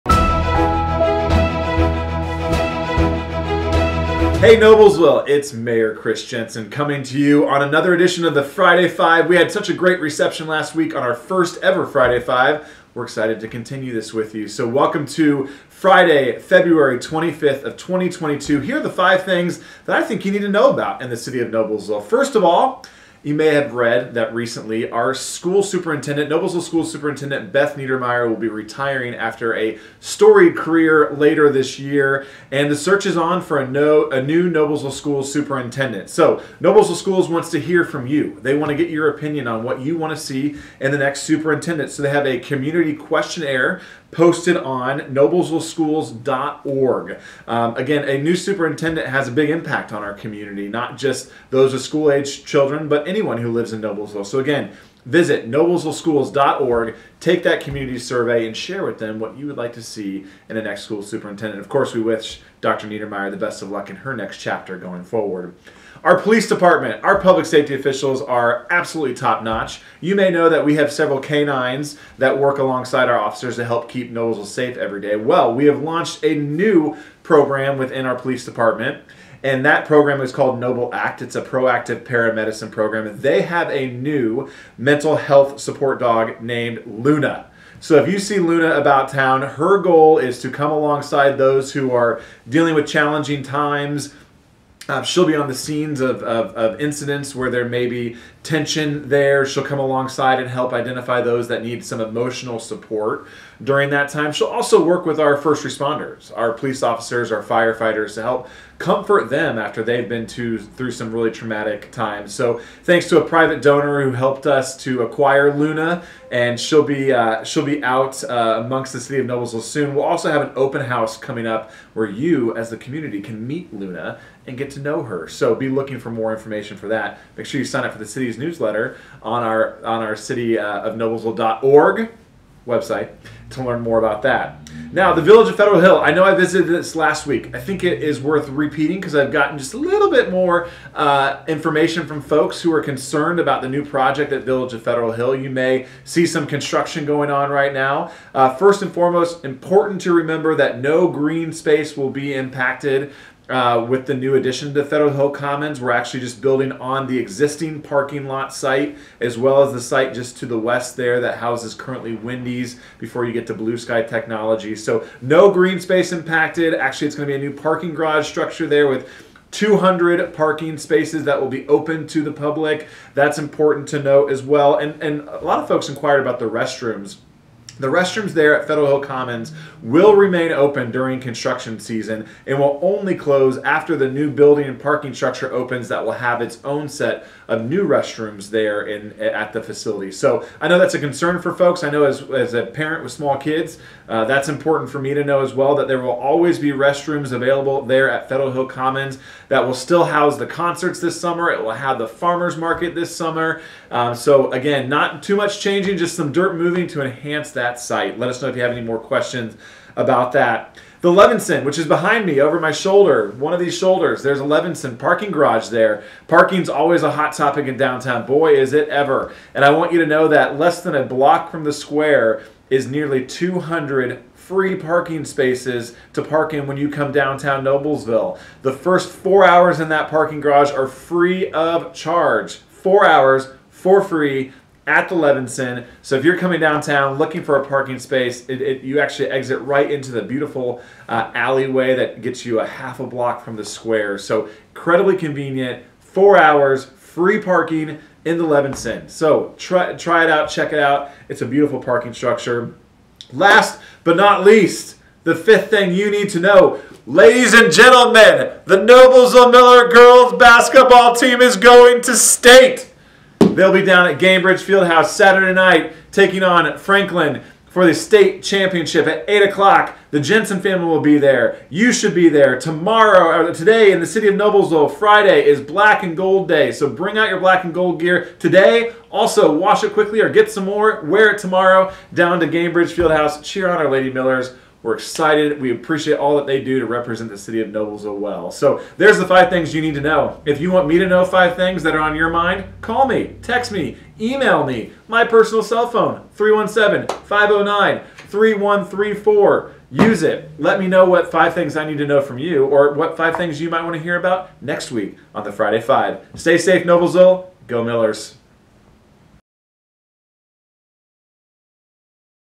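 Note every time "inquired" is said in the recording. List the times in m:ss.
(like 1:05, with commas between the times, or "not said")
2:55.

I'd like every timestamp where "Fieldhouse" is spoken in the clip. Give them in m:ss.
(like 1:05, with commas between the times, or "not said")
4:24, 4:42.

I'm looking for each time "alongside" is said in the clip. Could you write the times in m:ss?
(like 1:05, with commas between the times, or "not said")
1:12, 1:30, 1:39.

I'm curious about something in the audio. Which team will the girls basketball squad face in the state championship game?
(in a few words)
Franklin.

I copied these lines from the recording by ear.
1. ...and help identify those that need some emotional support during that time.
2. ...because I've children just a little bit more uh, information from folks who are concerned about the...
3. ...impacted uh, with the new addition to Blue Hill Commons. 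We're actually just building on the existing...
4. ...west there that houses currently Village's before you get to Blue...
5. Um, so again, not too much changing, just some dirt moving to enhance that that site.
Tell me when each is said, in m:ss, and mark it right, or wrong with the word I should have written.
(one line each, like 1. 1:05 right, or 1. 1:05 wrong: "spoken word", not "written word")
1. 1:40 right
2. 2:18 wrong: "gotten", not "children"
3. 2:32 wrong: "Federal", not "Blue"
4. 2:40 wrong: "Wendy", not "Village"
5. 3:23 right.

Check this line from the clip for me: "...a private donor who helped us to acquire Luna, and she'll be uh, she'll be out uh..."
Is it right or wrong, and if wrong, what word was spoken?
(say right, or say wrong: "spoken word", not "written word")
right.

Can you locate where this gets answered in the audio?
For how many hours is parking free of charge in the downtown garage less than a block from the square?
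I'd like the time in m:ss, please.
3:48.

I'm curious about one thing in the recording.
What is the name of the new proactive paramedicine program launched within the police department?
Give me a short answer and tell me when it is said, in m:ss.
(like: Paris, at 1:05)
Noble Act, at 1:20.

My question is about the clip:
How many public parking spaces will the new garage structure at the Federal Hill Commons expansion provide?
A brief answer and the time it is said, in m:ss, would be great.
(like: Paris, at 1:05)
200, at 2:49.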